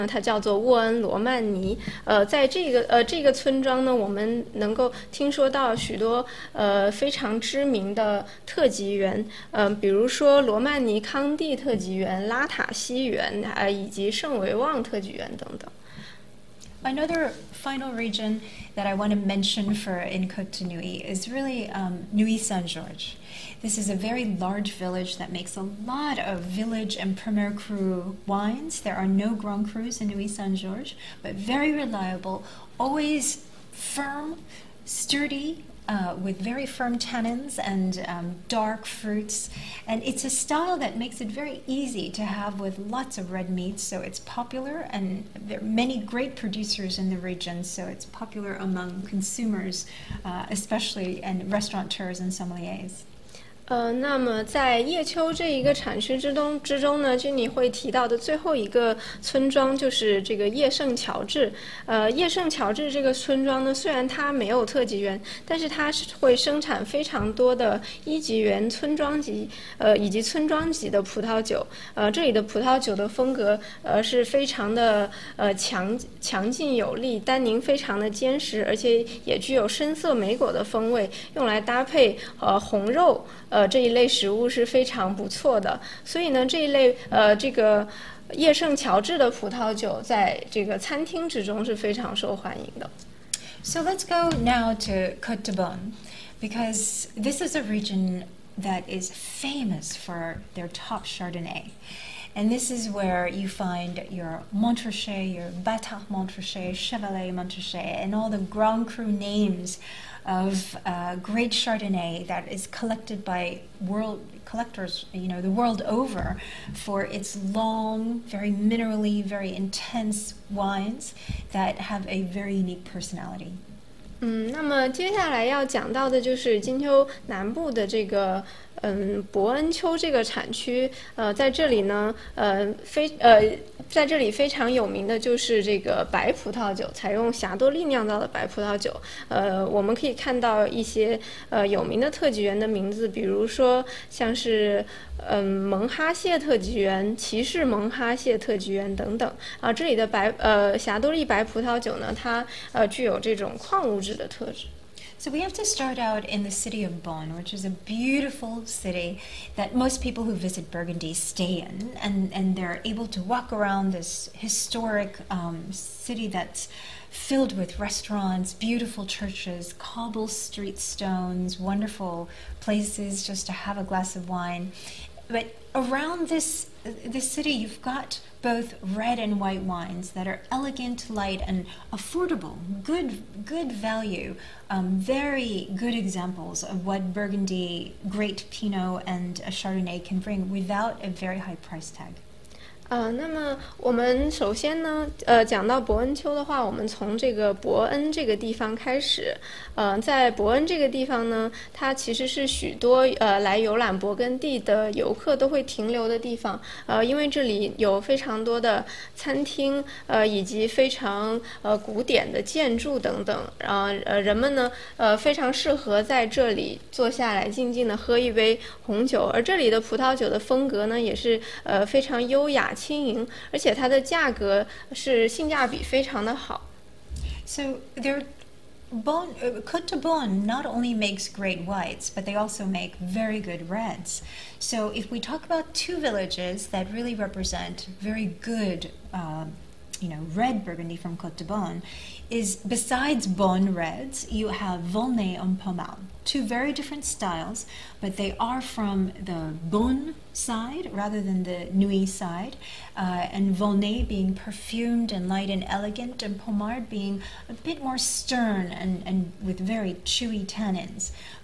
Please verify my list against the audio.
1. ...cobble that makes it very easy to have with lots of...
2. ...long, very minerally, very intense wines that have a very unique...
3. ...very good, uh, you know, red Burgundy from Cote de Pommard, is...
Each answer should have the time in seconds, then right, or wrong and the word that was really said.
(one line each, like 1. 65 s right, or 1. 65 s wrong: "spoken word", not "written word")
1. 40 s wrong: "style", not "cobble"
2. 117 s right
3. 237 s wrong: "Beaune", not "Pommard".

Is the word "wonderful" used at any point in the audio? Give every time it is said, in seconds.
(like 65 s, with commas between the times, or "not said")
171 s.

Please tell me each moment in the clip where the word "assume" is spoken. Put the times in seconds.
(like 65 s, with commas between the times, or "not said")
not said.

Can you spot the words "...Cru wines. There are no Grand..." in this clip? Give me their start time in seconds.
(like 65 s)
27 s.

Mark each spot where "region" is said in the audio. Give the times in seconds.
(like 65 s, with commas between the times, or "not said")
17 s, 47 s, 97 s.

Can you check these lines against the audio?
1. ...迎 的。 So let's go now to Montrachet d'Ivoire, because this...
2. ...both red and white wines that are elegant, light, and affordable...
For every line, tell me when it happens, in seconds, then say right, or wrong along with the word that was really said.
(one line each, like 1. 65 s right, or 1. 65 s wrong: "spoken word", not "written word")
1. 92 s wrong: "Cote", not "Montrachet"
2. 178 s right.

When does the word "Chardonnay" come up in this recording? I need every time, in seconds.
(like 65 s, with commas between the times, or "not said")
101 s, 111 s, 189 s.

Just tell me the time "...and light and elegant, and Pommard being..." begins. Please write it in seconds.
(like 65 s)
255 s.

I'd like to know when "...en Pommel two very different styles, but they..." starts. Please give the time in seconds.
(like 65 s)
245 s.